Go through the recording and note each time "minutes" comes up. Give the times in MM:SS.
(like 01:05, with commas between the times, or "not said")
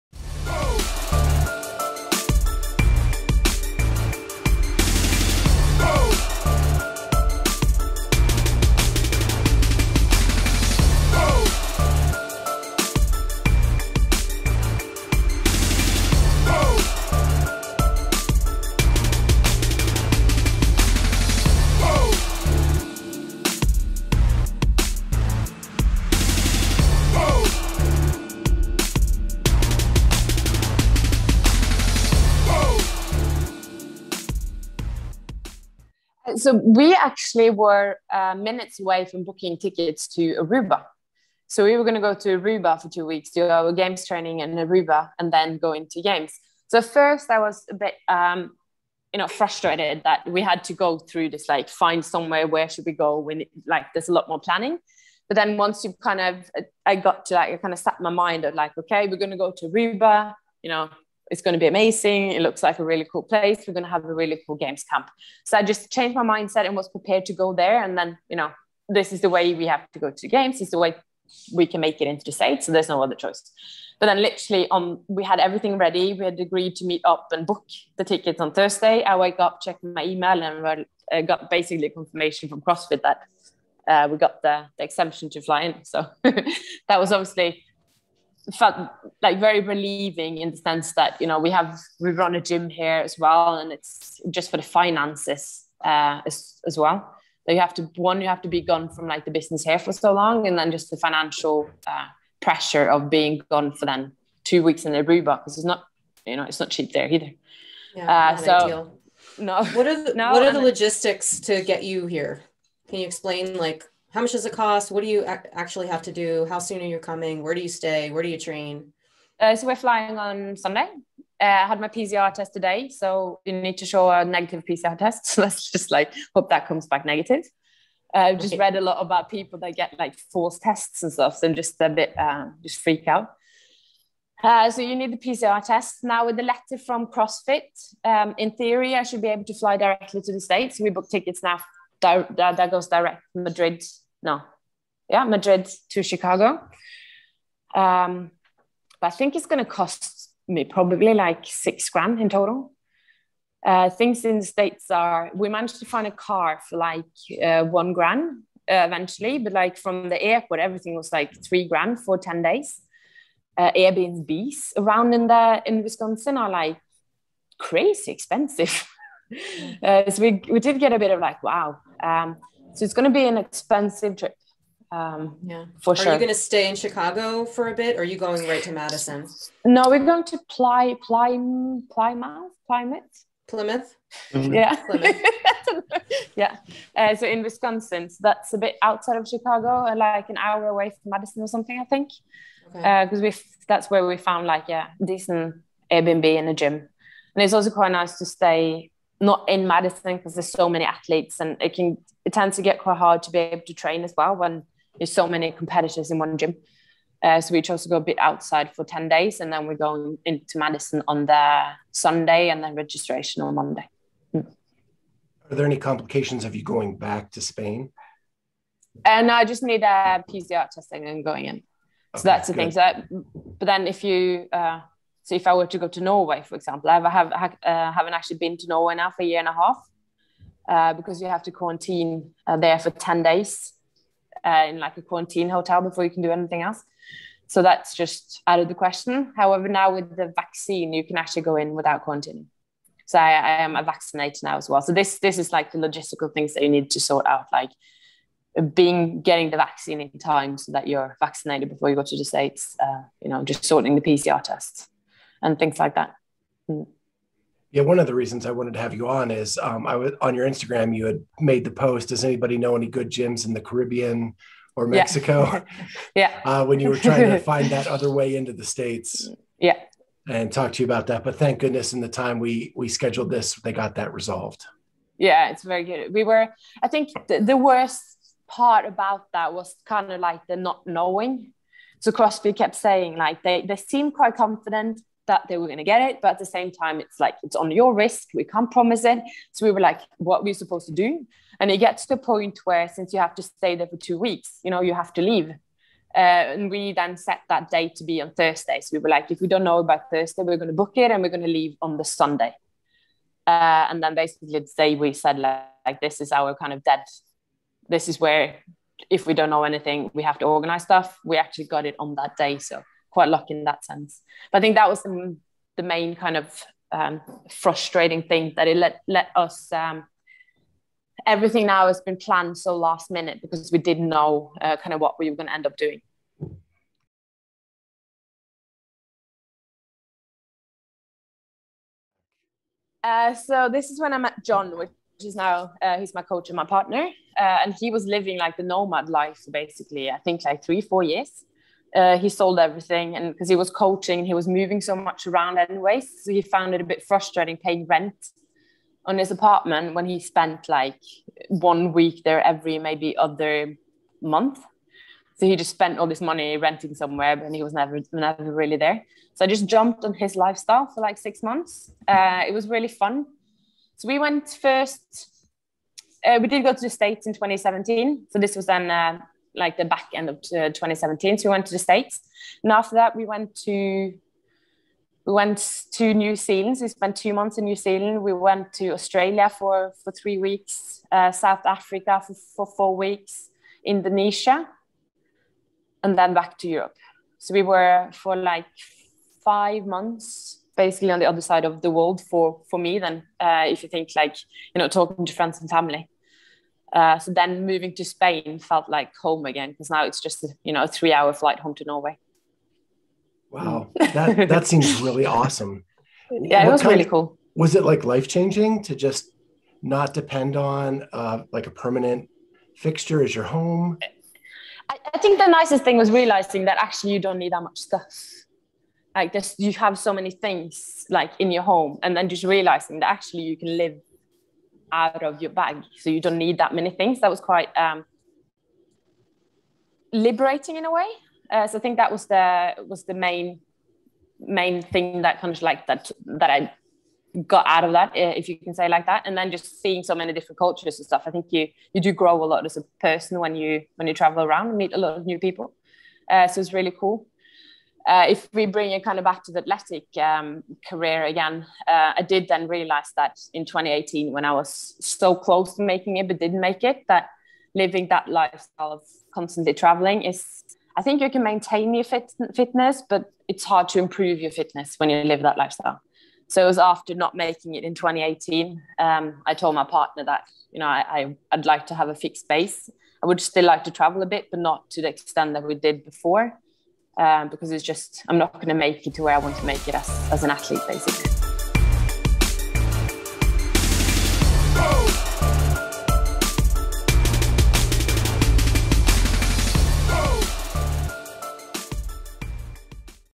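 00:38, 05:23.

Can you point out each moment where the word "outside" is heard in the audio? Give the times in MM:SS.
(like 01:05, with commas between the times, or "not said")
03:08, 03:28.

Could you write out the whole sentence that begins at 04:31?
But thank goodness, in the time we we scheduled this, they got that resolved.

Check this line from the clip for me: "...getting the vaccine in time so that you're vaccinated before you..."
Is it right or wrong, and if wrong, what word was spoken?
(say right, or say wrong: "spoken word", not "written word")
right.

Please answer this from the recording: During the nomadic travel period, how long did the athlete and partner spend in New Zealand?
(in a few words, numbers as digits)
2 months.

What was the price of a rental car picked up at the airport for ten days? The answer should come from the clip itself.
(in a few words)
three grand.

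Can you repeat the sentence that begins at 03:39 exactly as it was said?
And uh, I just need a uh, PCR testing and going in.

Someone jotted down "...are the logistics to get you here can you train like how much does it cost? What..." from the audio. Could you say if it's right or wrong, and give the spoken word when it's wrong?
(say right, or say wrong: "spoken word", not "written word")
wrong: "explain", not "train".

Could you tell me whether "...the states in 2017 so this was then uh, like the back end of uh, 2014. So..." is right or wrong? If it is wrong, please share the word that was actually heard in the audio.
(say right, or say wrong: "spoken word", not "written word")
wrong: "2017", not "2014".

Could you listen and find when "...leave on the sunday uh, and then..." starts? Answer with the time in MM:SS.
05:01.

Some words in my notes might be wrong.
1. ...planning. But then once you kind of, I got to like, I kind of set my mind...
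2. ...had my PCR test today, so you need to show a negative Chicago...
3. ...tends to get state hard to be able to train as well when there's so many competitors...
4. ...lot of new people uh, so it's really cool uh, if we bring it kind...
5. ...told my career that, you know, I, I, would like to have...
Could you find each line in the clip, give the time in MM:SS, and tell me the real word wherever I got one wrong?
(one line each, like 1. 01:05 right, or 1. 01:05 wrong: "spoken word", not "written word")
1. 00:54 right
2. 02:01 wrong: "PCR", not "Chicago"
3. 03:22 wrong: "quite", not "state"
4. 07:24 right
5. 07:49 wrong: "partner", not "career".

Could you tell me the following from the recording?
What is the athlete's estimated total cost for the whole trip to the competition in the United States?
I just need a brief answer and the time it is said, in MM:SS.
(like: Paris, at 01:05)
six grand, at 02:31.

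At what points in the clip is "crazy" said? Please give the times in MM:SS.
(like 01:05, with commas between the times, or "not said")
02:47.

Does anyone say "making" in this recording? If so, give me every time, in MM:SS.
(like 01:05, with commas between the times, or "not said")
07:35, 07:47.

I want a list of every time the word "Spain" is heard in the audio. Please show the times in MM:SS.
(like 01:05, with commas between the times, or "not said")
03:37, 06:38.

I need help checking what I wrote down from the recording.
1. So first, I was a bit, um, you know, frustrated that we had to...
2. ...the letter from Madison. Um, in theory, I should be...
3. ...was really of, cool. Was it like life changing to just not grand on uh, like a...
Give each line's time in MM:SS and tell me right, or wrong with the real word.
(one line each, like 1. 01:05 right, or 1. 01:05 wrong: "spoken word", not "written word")
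1. 00:46 right
2. 02:16 wrong: "CrossFit", not "Madison"
3. 06:46 wrong: "depend", not "grand".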